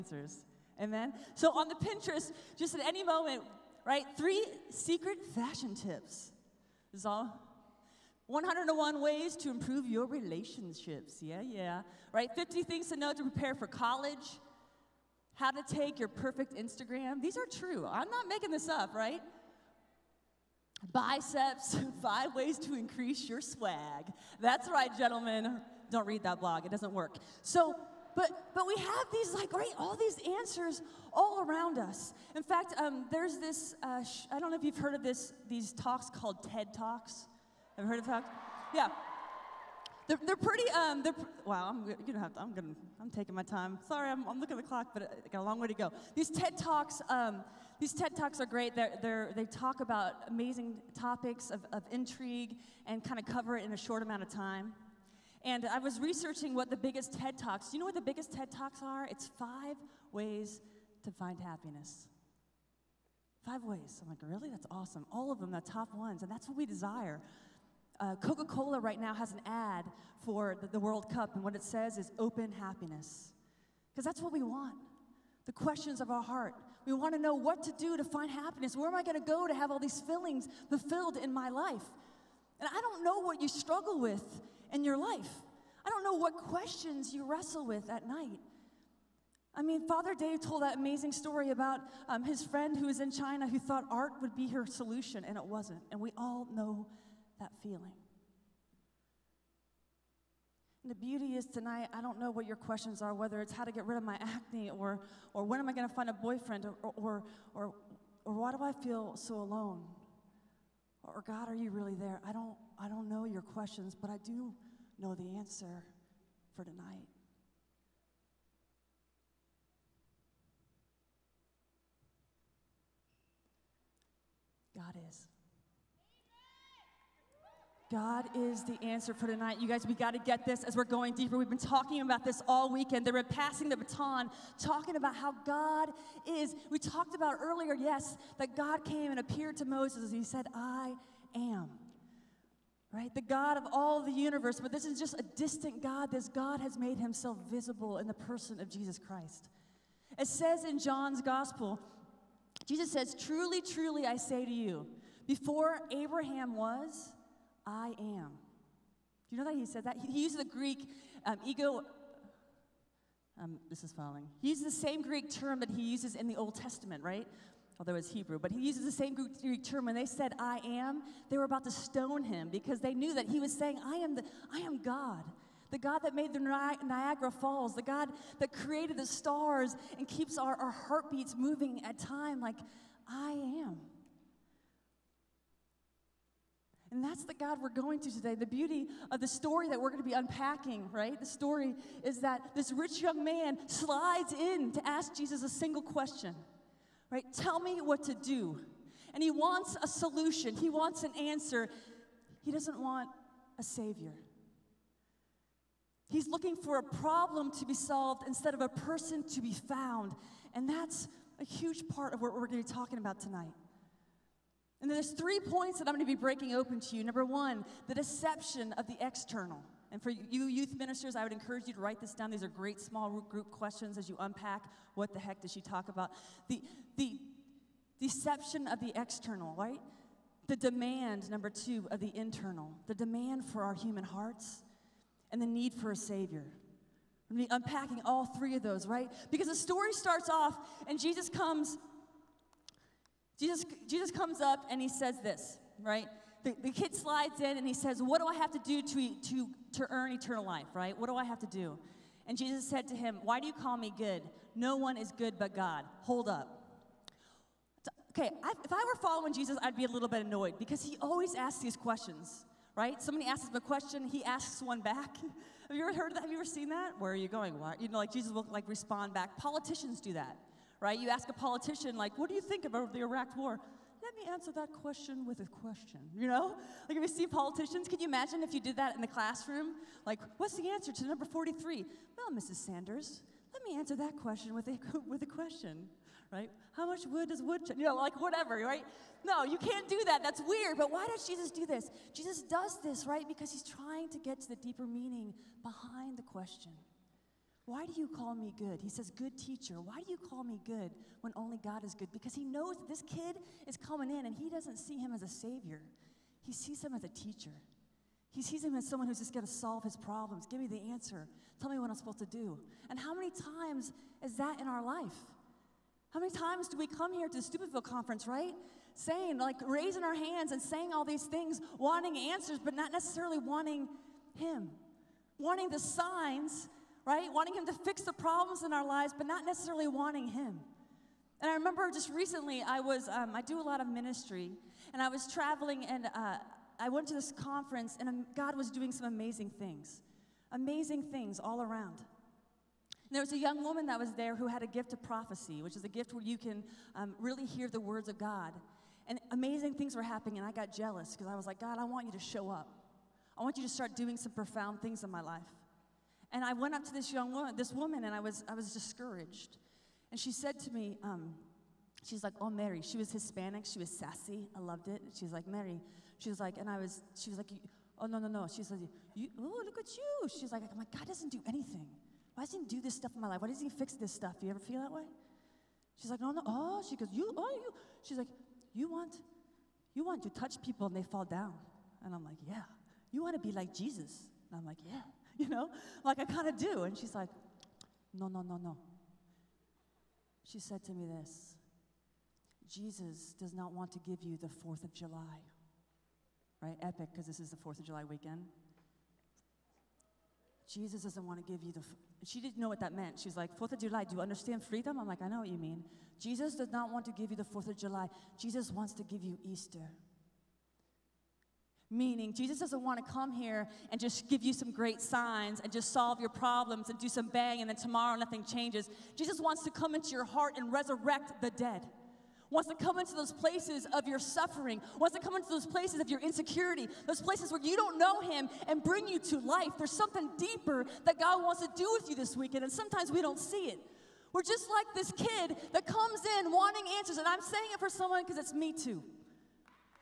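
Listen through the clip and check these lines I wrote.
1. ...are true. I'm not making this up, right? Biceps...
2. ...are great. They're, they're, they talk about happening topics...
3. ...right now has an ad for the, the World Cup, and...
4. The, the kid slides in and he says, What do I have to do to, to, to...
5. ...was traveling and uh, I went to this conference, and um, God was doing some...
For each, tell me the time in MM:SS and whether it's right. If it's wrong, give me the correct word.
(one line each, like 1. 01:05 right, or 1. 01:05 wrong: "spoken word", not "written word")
1. 00:17 right
2. 00:48 wrong: "amazing", not "happening"
3. 01:08 right
4. 04:06 right
5. 05:35 right.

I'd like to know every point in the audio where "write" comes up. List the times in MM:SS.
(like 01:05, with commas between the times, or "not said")
03:41.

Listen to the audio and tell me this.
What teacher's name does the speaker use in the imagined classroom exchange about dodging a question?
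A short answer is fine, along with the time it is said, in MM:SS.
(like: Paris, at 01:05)
Mrs. Sanders, at 04:42.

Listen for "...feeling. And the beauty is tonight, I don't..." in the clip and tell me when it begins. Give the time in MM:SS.
01:37.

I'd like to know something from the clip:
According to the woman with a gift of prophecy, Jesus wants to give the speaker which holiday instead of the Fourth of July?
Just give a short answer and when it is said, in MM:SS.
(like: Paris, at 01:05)
Easter, at 06:49.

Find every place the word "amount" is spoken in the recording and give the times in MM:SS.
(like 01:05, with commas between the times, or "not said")
00:54.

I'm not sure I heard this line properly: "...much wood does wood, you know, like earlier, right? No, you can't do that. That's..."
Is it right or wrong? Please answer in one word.
wrong.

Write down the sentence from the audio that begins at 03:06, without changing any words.
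And that's the God we're going to today.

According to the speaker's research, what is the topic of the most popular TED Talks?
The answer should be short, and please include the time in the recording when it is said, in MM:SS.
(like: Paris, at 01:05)
Five ways to find happiness, at 00:59.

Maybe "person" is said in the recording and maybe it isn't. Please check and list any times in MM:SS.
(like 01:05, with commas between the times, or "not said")
02:28, 03:28.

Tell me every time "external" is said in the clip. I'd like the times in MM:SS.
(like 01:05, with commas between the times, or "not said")
03:38, 03:48.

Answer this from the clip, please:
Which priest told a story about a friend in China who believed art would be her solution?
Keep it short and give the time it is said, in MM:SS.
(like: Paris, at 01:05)
Father Dave, at 01:29.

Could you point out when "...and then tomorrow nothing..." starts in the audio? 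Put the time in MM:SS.
06:57.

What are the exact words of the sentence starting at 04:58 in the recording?
He says, Good teacher, why do you call me good when only God is good?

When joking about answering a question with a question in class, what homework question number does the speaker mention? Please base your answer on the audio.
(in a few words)
43.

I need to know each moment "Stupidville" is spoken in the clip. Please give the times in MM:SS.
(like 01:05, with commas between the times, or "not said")
05:17.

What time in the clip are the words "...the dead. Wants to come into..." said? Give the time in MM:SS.
07:01.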